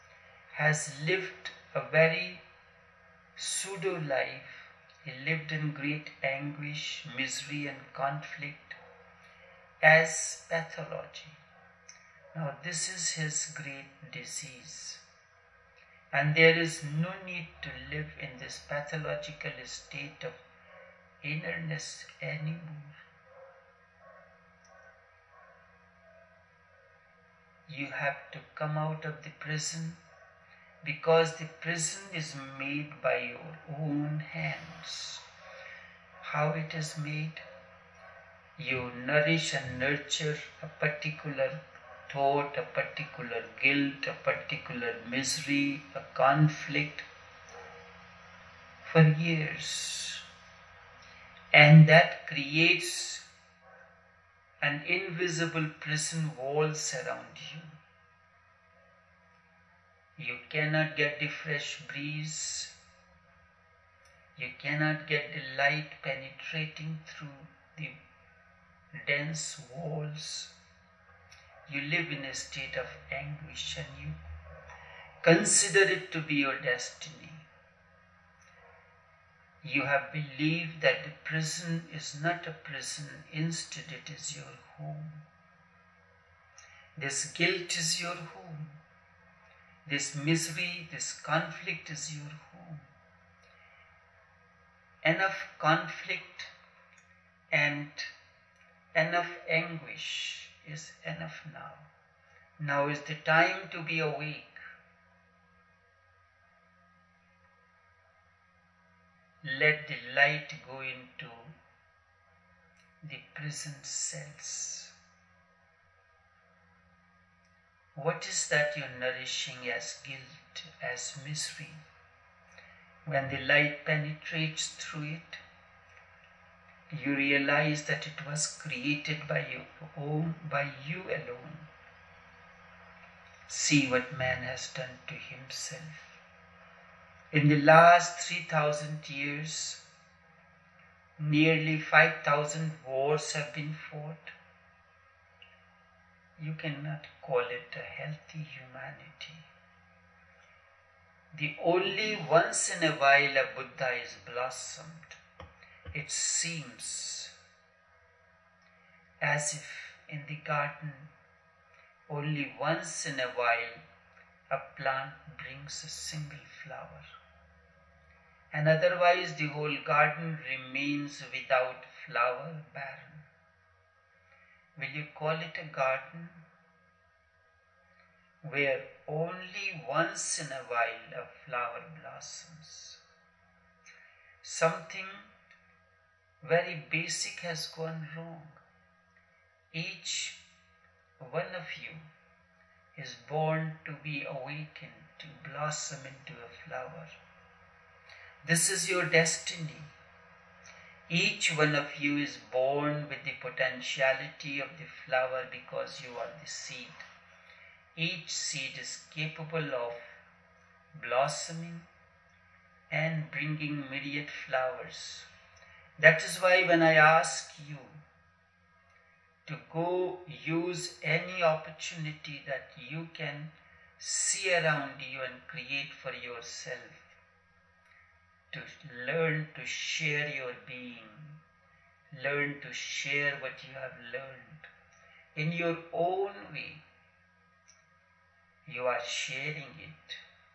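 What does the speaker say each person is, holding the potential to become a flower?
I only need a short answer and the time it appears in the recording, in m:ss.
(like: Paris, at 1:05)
the seed, at 3:26.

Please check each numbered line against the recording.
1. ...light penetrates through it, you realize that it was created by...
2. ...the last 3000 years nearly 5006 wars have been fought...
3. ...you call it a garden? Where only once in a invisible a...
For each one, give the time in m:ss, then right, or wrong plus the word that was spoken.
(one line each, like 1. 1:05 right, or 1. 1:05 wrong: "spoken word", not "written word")
1. 2:03 right
2. 2:17 wrong: "5000", not "5006"
3. 2:54 wrong: "while", not "invisible".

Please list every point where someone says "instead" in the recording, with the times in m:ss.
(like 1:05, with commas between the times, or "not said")
1:23.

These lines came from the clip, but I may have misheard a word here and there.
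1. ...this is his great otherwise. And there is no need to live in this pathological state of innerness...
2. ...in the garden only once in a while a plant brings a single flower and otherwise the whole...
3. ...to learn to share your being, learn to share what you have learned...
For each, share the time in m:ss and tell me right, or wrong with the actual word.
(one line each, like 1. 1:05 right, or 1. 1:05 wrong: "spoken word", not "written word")
1. 0:12 wrong: "disease", not "otherwise"
2. 2:40 right
3. 3:48 right.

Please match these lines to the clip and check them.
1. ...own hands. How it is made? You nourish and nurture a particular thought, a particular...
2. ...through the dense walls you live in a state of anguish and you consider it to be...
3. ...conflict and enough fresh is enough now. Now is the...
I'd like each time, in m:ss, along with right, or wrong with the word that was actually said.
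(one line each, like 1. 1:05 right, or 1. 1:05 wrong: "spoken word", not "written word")
1. 0:33 right
2. 1:07 right
3. 1:35 wrong: "anguish", not "fresh".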